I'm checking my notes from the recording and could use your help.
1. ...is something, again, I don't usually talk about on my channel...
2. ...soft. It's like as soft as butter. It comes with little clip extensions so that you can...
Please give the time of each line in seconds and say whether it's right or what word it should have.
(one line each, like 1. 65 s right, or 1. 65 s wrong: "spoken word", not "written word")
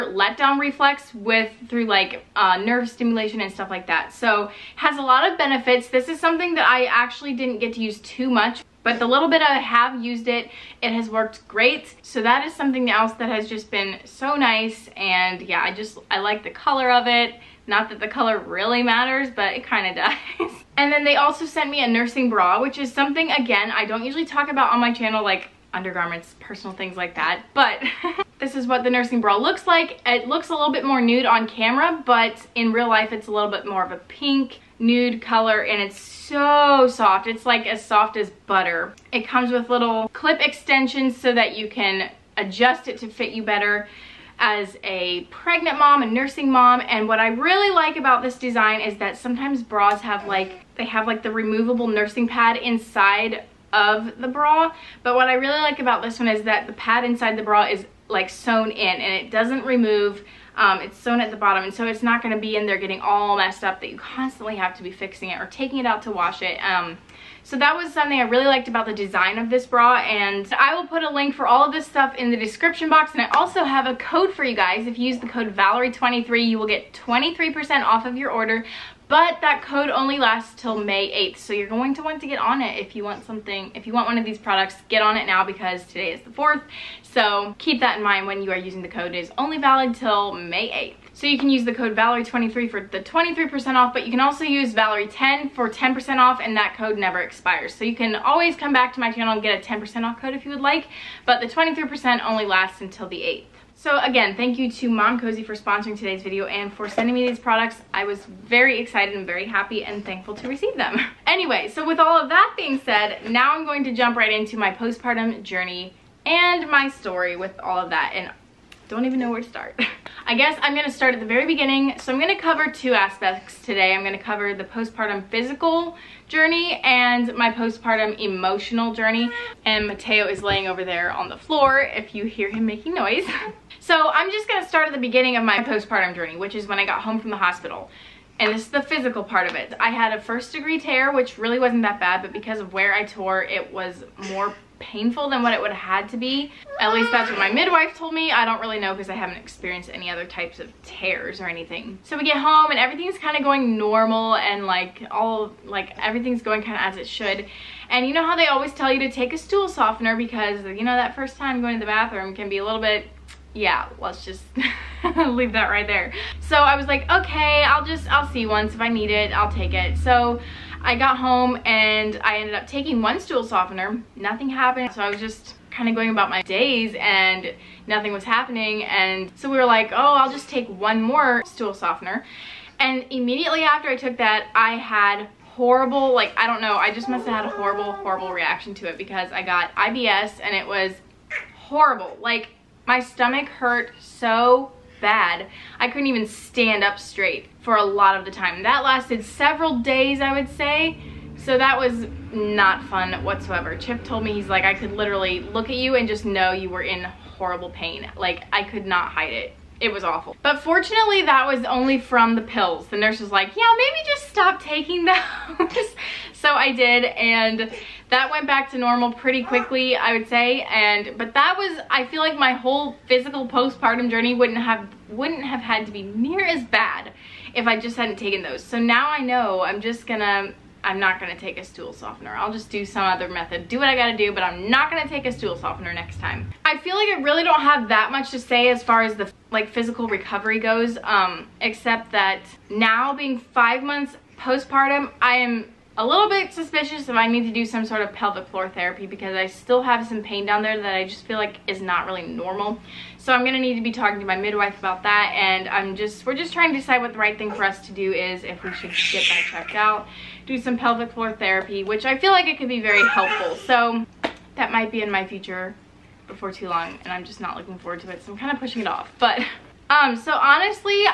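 1. 22 s right
2. 36 s right.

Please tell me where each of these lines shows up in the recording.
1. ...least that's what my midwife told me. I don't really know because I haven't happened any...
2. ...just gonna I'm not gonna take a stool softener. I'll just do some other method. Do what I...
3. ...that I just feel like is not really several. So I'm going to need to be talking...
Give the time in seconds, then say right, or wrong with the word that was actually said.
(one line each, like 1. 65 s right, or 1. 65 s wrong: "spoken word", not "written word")
1. 146 s wrong: "experienced", not "happened"
2. 229 s right
3. 250 s wrong: "normal", not "several".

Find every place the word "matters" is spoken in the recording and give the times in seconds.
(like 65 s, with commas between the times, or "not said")
18 s.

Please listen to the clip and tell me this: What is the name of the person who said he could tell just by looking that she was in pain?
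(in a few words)
Chip.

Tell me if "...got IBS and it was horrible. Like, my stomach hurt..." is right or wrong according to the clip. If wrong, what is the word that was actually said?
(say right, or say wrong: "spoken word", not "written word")
right.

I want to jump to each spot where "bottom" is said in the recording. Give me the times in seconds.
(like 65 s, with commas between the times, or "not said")
61 s.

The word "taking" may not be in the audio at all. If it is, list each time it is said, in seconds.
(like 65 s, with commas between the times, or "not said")
65 s, 172 s, 214 s.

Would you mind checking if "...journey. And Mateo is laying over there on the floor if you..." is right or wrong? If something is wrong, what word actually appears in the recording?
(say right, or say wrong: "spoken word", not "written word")
right.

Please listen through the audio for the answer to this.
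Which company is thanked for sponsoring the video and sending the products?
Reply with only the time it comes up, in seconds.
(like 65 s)
104 s.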